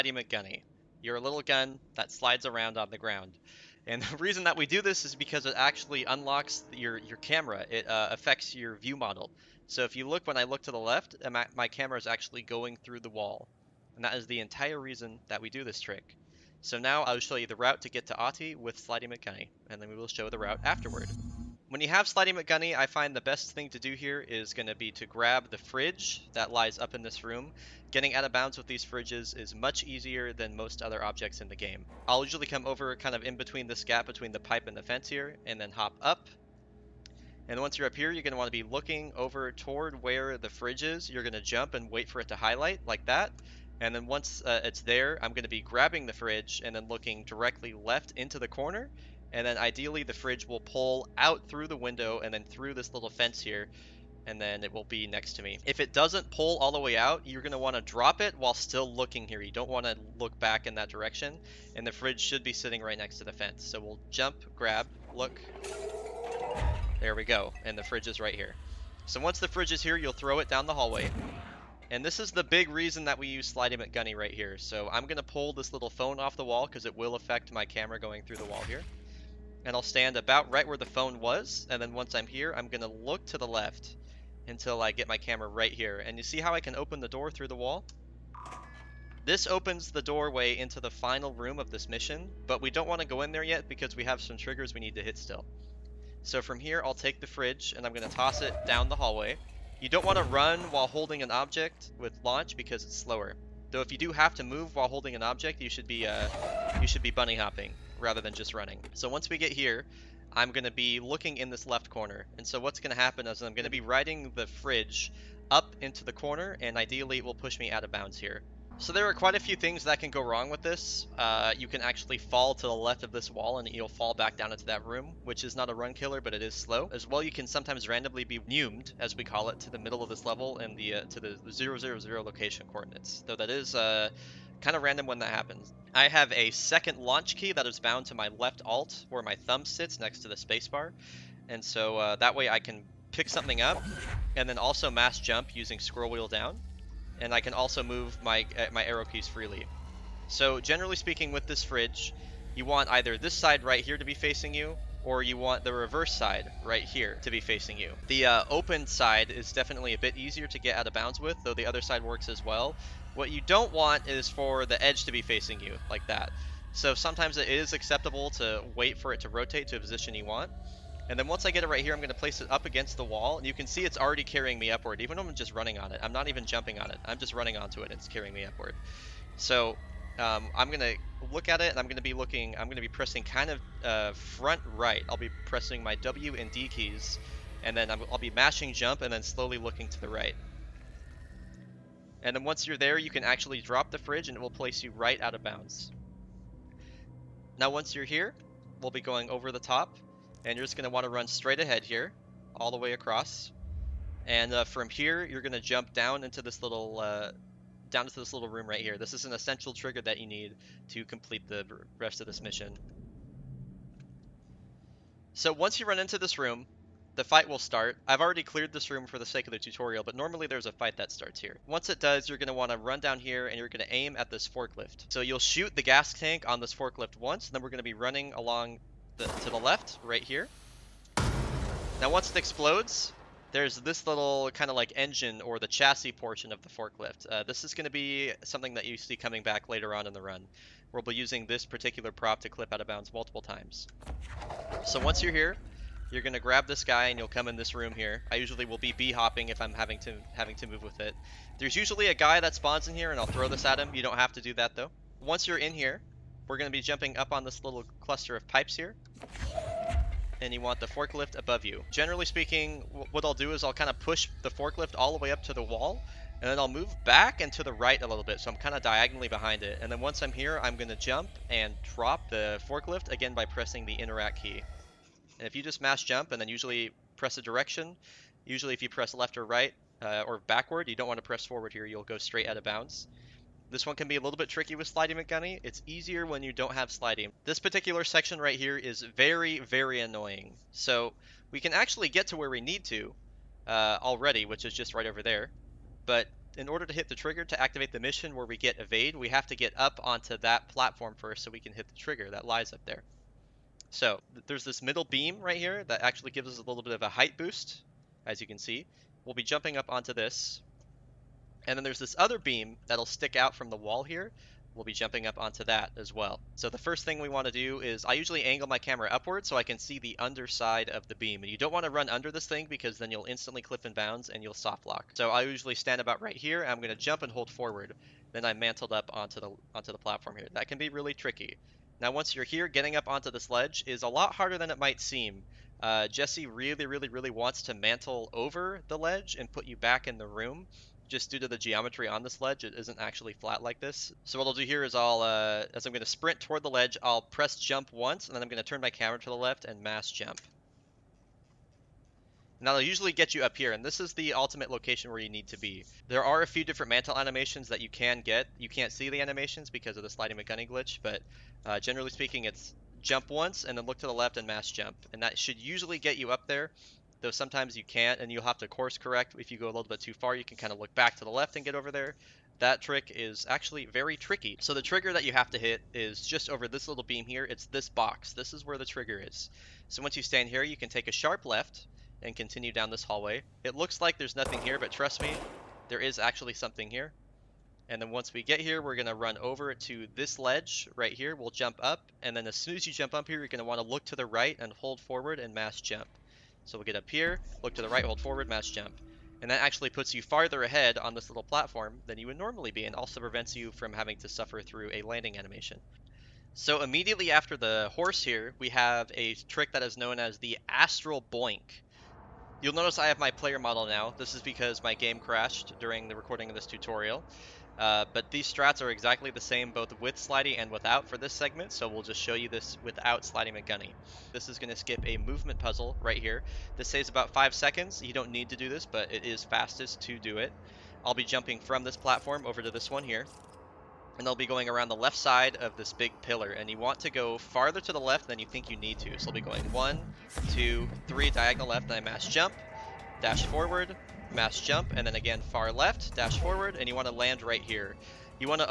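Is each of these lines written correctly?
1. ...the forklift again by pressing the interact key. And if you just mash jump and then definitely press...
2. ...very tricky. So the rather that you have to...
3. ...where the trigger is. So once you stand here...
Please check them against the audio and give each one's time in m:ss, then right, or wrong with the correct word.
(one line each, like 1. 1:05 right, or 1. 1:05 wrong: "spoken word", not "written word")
1. 4:32 wrong: "usually", not "definitely"
2. 6:13 wrong: "trigger", not "rather"
3. 6:18 right.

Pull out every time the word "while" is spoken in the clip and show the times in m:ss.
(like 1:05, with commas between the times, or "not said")
0:58, 1:40, 1:44.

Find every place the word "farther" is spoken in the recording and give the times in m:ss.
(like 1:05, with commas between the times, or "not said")
6:40, 7:17.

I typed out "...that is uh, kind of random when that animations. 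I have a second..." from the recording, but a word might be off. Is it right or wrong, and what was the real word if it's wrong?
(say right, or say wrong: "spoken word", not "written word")
wrong: "happens", not "animations".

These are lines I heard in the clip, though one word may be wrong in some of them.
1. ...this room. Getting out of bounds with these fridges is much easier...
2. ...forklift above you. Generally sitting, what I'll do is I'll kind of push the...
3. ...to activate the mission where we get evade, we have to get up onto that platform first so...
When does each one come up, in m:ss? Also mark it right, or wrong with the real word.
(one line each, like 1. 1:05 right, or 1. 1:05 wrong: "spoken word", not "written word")
1. 0:27 right
2. 4:20 wrong: "speaking", not "sitting"
3. 4:57 right.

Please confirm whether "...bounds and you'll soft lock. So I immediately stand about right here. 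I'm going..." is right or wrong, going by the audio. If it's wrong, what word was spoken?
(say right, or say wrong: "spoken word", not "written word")
wrong: "usually", not "immediately".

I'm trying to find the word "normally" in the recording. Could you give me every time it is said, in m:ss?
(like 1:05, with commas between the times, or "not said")
3:40, 6:42.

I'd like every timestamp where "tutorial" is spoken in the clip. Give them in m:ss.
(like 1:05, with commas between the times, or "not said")
3:39, 6:56.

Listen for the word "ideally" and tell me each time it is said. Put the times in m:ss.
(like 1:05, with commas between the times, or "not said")
0:49, 1:56.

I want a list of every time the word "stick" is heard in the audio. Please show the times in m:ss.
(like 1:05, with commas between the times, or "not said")
5:13.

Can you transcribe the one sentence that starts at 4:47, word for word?
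This particular section right here is very, very annoying.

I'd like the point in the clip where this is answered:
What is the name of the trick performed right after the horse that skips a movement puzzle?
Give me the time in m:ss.
6:50.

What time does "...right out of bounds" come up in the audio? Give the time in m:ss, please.
3:14.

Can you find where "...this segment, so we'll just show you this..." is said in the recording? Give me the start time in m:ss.
7:01.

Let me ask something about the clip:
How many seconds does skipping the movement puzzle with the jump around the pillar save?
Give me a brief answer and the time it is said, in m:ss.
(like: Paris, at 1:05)
5, at 7:07.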